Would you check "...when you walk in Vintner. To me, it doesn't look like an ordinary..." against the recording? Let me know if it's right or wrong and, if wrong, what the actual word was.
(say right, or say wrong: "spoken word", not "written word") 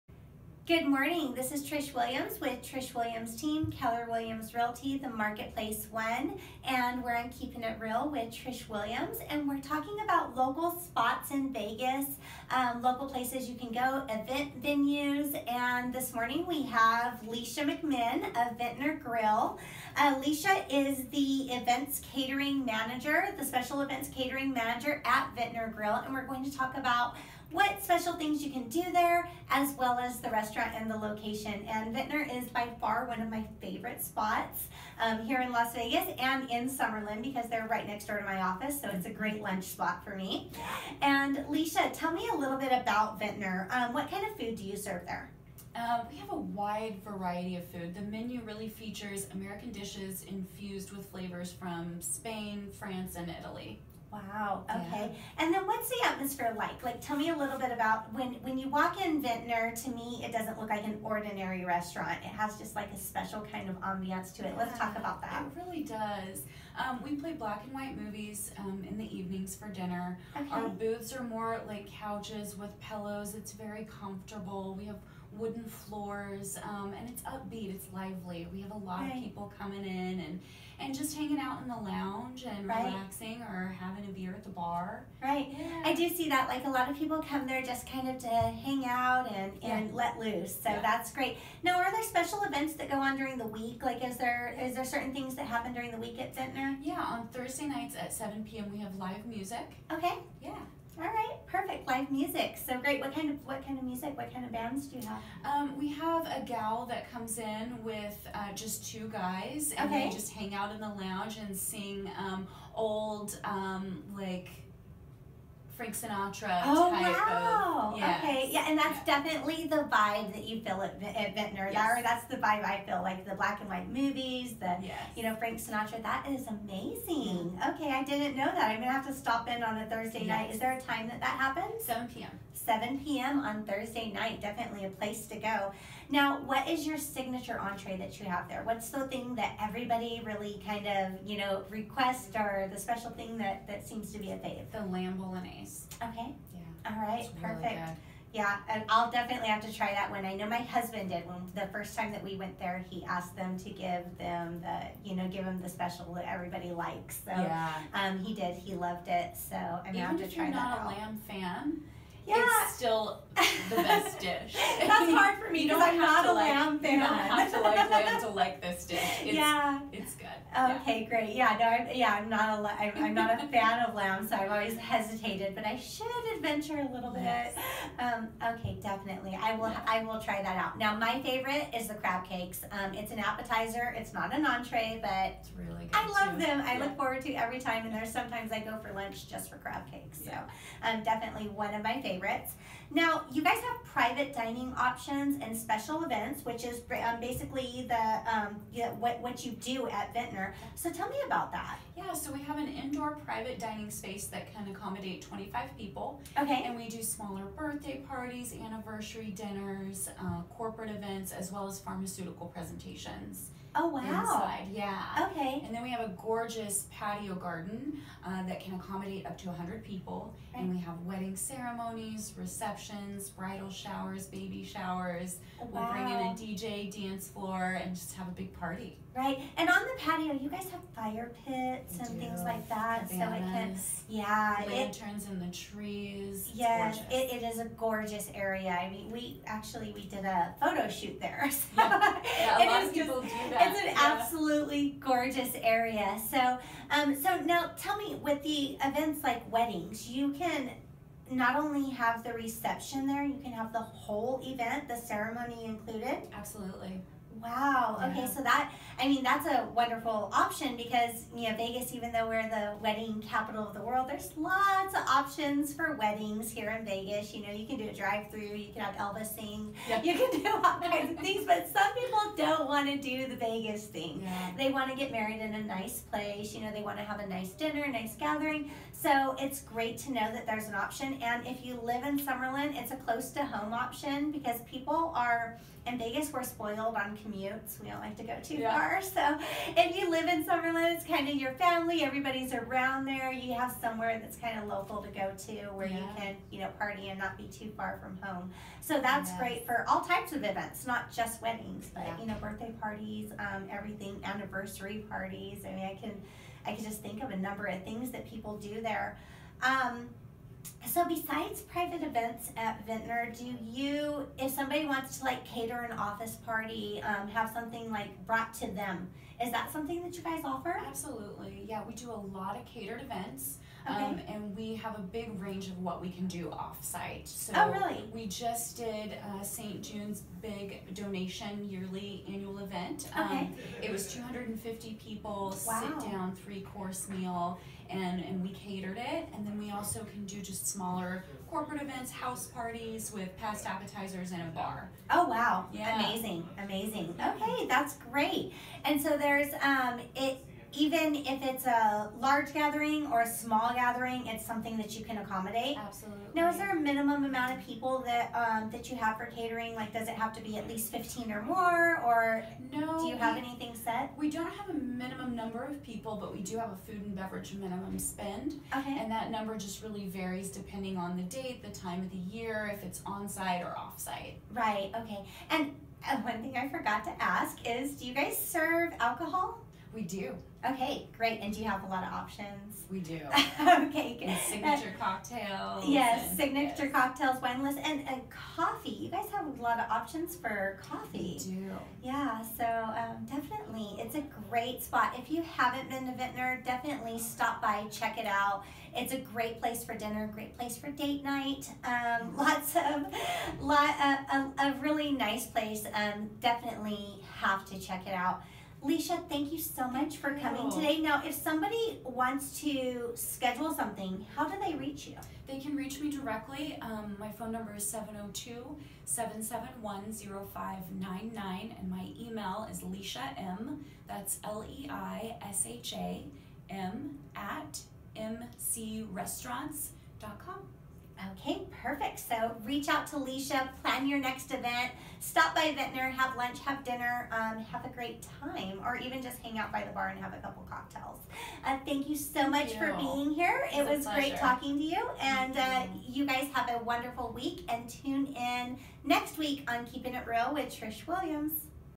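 right.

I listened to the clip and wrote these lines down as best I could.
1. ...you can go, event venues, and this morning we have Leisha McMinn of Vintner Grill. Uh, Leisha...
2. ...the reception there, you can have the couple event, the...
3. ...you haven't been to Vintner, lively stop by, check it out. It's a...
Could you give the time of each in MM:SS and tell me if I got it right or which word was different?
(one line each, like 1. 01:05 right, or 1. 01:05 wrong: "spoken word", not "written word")
1. 00:13 right
2. 04:12 wrong: "whole", not "couple"
3. 06:35 wrong: "definitely", not "lively".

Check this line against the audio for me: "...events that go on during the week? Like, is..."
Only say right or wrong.
right.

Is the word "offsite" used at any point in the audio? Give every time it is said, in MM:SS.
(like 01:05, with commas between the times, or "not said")
05:26.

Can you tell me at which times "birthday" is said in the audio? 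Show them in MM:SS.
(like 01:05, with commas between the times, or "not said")
03:27, 05:02.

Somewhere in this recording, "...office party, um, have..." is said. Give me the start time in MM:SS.
05:15.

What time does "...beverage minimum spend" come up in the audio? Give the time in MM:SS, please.
06:07.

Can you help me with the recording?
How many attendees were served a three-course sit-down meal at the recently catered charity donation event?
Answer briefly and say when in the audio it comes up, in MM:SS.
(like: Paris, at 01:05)
250, at 05:34.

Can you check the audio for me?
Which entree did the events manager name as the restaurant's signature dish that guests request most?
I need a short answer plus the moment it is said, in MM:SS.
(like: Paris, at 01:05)
Lamb bolognese, at 02:24.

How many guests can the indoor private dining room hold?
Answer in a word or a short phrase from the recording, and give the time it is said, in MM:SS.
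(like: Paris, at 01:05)
25, at 03:25.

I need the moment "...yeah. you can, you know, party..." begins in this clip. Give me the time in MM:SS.
04:55.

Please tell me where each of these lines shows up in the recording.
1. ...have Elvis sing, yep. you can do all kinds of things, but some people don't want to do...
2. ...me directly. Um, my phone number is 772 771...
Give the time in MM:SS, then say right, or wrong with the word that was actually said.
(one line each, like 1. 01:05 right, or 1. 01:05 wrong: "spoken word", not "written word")
1. 04:28 right
2. 06:56 wrong: "702", not "772".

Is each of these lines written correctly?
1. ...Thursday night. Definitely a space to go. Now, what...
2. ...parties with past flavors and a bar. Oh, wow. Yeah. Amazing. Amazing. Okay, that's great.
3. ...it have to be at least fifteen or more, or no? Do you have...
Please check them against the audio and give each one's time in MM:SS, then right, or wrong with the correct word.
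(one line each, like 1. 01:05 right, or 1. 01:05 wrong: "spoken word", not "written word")
1. 02:13 wrong: "place", not "space"
2. 05:42 wrong: "appetizers", not "flavors"
3. 06:00 right.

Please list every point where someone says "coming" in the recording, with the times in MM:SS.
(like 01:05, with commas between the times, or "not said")
01:19, 06:50.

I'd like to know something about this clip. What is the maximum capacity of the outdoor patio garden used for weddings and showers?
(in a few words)
100.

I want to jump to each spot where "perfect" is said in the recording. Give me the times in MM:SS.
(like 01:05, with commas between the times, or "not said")
01:41, 02:27, 07:11.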